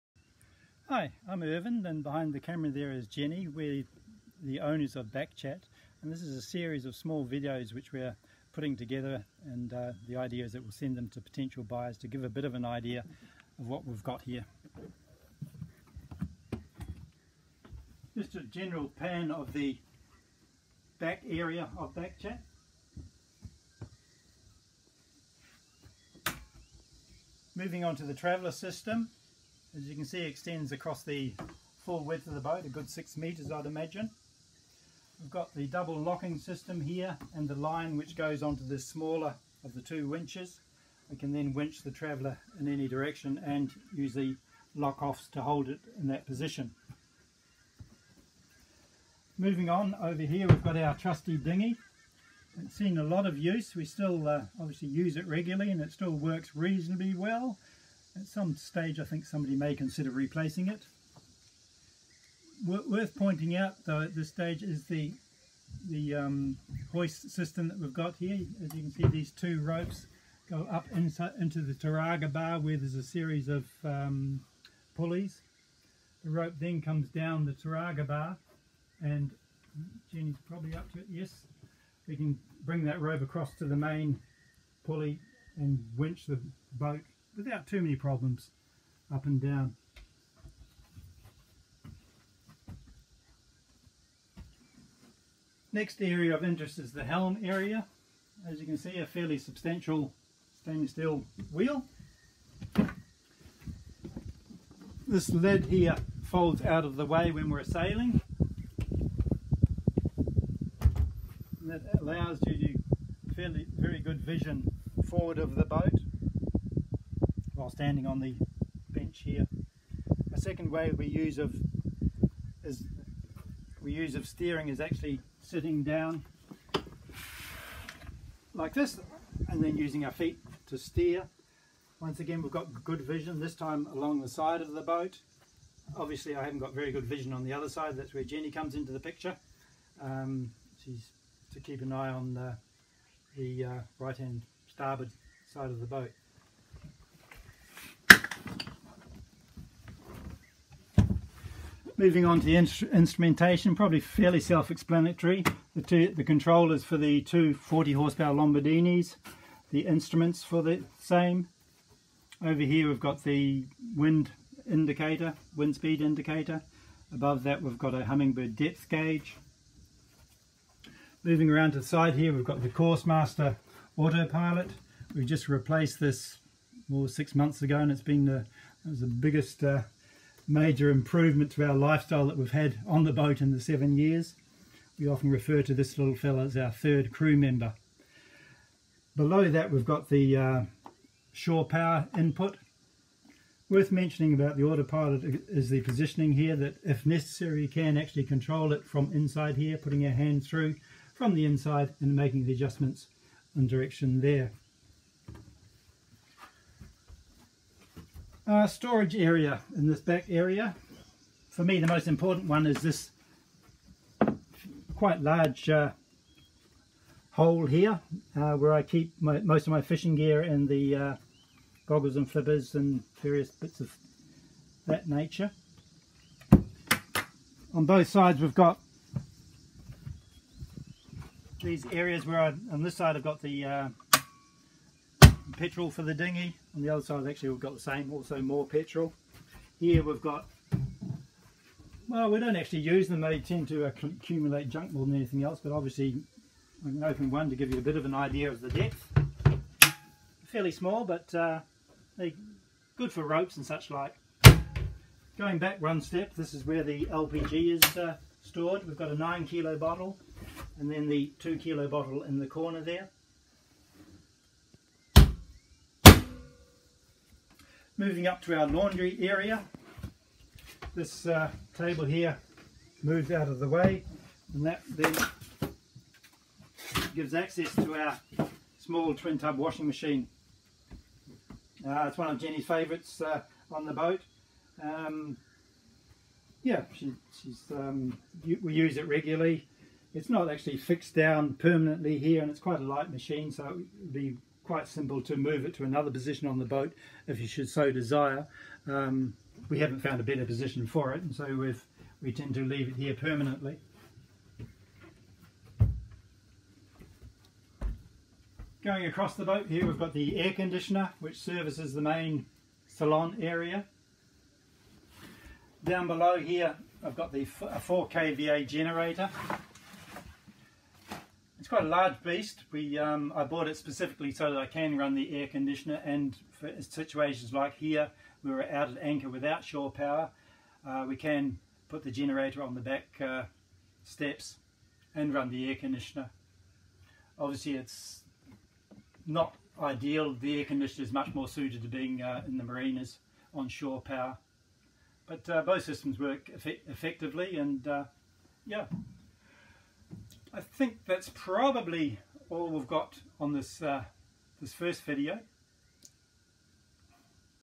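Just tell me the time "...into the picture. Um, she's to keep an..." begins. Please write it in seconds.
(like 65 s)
138 s.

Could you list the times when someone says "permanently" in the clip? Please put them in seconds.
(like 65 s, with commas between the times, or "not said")
291 s, 303 s.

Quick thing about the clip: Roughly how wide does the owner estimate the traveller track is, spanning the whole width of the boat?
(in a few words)
6 meters.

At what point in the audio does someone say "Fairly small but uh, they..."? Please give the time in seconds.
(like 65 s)
250 s.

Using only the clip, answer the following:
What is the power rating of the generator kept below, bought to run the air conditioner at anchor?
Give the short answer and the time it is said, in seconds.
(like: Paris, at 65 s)
4 kVA, at 317 s.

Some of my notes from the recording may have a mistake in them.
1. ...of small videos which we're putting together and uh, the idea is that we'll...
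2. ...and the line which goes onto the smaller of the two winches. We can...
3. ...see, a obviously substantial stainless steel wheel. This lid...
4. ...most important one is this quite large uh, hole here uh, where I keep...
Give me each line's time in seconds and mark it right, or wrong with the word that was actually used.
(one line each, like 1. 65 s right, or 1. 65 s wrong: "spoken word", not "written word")
1. 6 s right
2. 37 s right
3. 98 s wrong: "fairly", not "obviously"
4. 211 s right.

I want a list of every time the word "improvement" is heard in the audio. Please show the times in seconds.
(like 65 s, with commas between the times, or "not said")
180 s.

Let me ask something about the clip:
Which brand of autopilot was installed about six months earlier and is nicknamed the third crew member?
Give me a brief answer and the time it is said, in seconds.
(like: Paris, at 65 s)
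Coursemaster, at 172 s.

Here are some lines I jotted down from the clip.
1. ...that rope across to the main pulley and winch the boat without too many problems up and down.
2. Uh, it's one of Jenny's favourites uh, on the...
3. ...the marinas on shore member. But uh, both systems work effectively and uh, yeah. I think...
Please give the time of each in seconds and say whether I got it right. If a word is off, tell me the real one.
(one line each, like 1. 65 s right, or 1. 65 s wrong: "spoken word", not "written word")
1. 82 s right
2. 281 s right
3. 342 s wrong: "power", not "member".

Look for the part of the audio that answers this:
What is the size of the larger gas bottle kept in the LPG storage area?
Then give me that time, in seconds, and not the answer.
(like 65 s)
259 s.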